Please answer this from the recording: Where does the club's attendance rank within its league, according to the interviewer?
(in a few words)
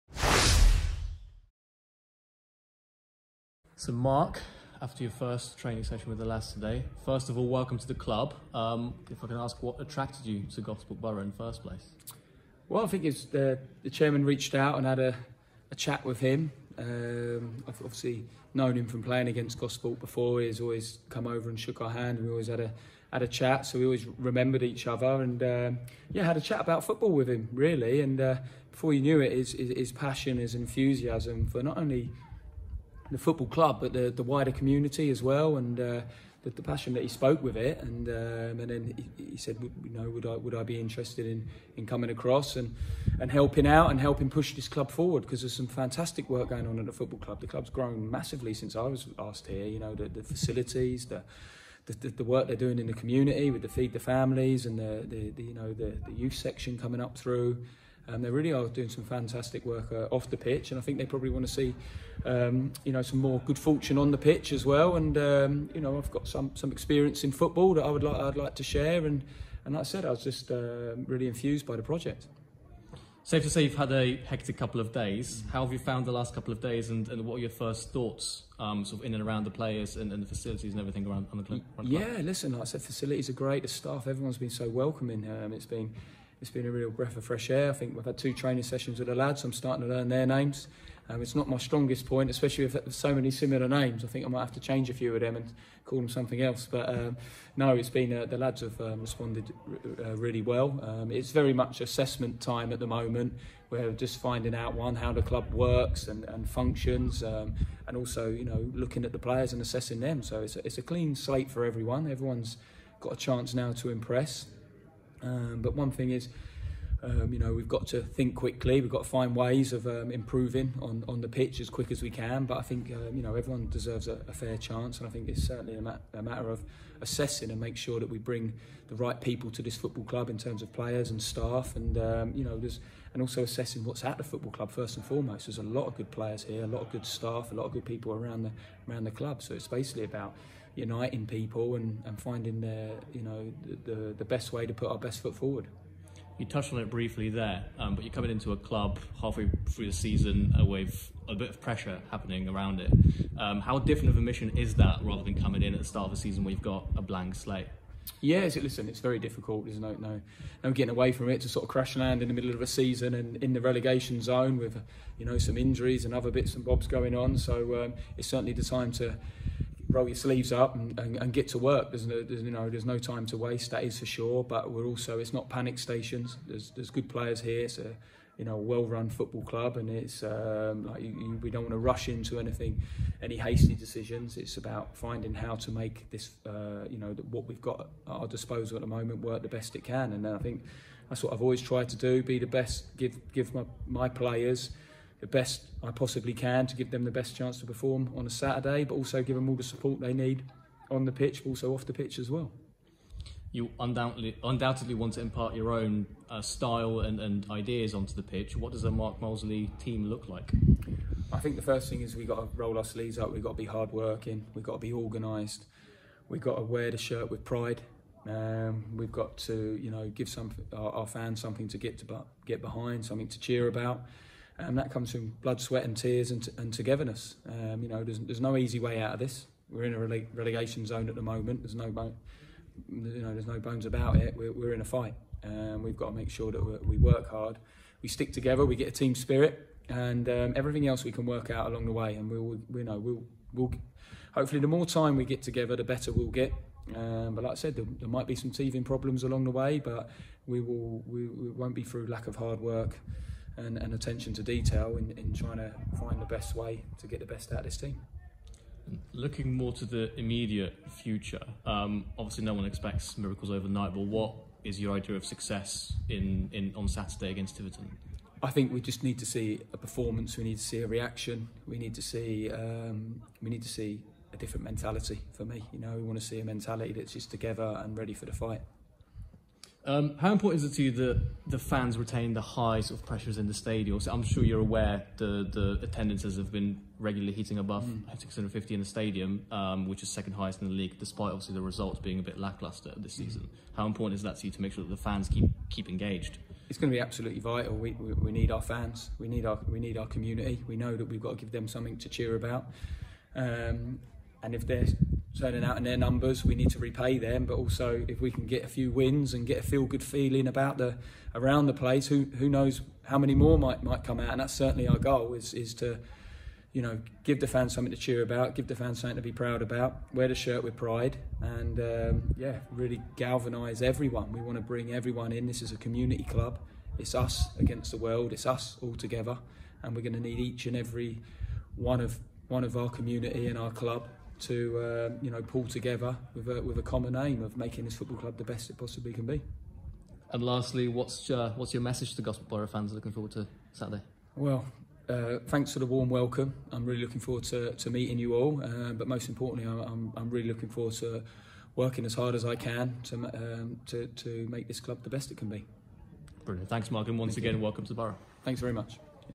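Second highest.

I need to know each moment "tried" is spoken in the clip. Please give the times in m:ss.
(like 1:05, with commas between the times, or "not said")
3:11.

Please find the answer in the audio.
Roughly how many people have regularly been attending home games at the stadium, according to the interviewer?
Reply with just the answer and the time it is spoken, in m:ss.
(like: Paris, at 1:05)
650, at 4:48.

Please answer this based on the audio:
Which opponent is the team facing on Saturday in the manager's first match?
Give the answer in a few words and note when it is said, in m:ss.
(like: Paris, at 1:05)
Tiverton, at 4:27.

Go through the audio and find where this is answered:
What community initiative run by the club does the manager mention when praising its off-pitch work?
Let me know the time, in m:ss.
0:53.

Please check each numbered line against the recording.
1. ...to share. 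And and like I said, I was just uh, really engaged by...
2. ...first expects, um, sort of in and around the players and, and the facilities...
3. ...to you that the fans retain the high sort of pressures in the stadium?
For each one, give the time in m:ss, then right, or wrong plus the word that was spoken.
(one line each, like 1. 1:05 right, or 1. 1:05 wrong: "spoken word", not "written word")
1. 1:08 wrong: "infused", not "engaged"
2. 1:17 wrong: "thoughts", not "expects"
3. 4:40 right.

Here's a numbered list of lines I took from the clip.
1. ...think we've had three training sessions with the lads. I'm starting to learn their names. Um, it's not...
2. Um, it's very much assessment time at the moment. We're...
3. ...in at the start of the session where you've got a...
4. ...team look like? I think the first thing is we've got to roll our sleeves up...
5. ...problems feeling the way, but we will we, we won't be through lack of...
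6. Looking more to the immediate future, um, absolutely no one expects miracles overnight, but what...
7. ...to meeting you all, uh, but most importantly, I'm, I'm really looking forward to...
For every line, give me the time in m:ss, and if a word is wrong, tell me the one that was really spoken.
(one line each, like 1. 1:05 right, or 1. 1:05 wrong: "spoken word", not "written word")
1. 1:27 wrong: "two", not "three"
2. 1:40 right
3. 2:35 wrong: "season", not "session"
4. 3:29 right
5. 4:08 wrong: "along", not "feeling"
6. 4:19 wrong: "obviously", not "absolutely"
7. 5:47 right.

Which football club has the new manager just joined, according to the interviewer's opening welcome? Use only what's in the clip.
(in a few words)
Gosport Borough.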